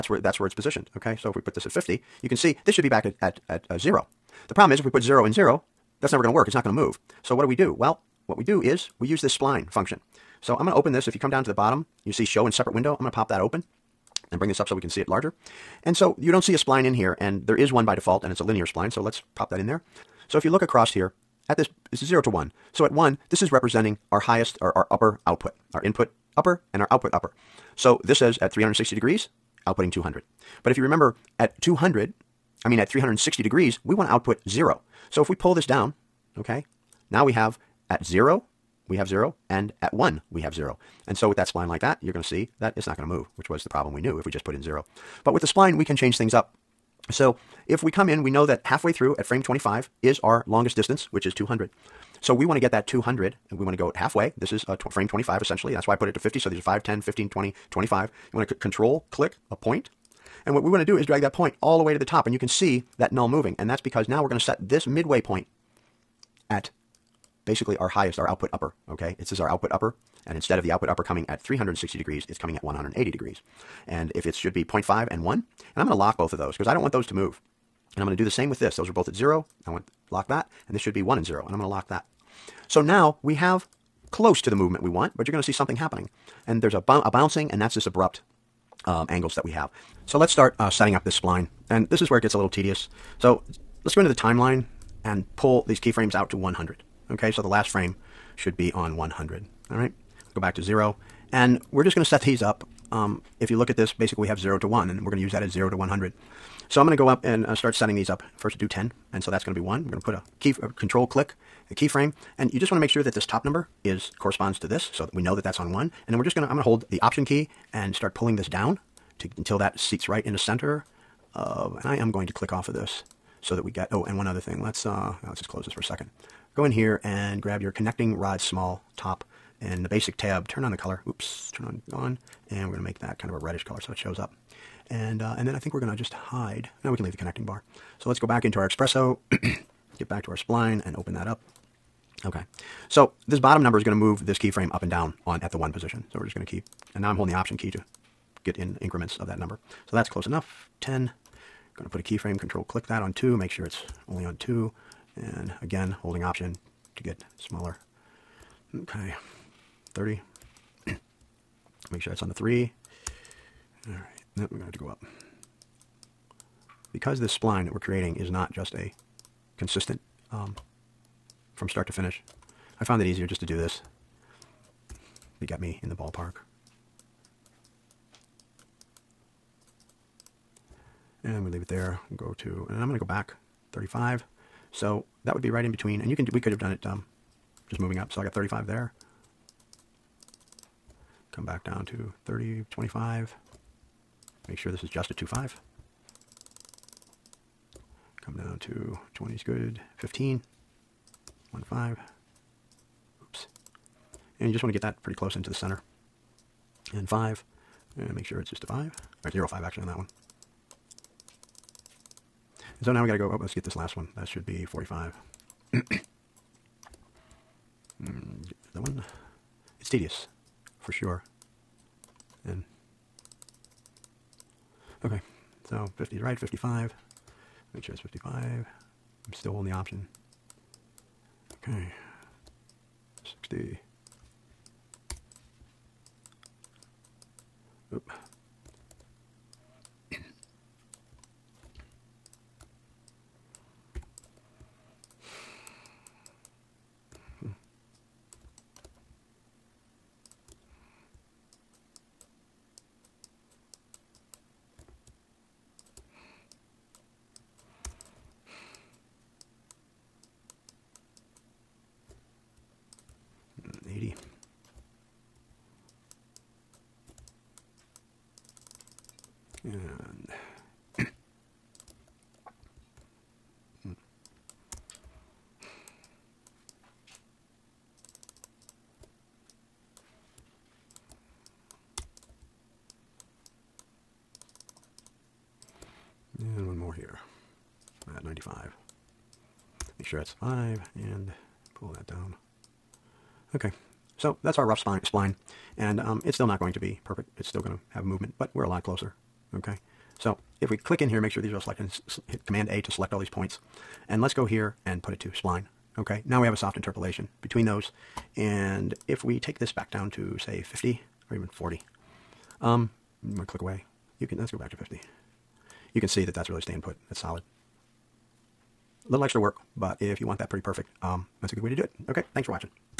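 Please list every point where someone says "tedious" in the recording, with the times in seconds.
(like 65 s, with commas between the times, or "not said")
92 s, 219 s.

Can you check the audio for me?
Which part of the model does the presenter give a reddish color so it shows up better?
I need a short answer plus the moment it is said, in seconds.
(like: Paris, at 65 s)
Connecting rod small top, at 127 s.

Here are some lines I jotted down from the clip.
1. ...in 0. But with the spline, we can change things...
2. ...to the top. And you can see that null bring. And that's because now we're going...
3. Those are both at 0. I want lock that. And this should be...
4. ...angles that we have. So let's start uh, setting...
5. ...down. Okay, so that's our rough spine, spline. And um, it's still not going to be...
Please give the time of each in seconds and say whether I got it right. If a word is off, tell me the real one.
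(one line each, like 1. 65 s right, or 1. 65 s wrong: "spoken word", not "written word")
1. 44 s right
2. 61 s wrong: "moving", not "bring"
3. 78 s right
4. 89 s right
5. 292 s right.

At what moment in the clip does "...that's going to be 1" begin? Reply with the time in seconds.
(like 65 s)
109 s.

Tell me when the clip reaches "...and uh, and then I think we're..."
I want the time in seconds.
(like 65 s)
134 s.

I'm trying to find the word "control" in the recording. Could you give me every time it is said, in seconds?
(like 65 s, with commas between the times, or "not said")
58 s, 110 s, 152 s.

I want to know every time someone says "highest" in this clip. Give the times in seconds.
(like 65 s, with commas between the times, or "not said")
24 s, 67 s.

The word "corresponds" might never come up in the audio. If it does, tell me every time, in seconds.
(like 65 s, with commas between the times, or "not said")
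114 s.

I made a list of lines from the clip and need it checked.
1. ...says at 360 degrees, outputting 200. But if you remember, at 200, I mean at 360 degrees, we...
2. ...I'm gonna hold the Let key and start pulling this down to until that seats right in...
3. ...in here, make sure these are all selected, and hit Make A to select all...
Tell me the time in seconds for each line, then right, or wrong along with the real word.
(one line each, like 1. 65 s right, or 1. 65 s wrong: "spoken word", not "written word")
1. 28 s right
2. 116 s wrong: "Option", not "Let"
3. 301 s wrong: "Command", not "Make".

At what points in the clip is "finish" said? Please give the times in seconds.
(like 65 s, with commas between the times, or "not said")
171 s.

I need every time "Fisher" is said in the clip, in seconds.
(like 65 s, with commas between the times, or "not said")
not said.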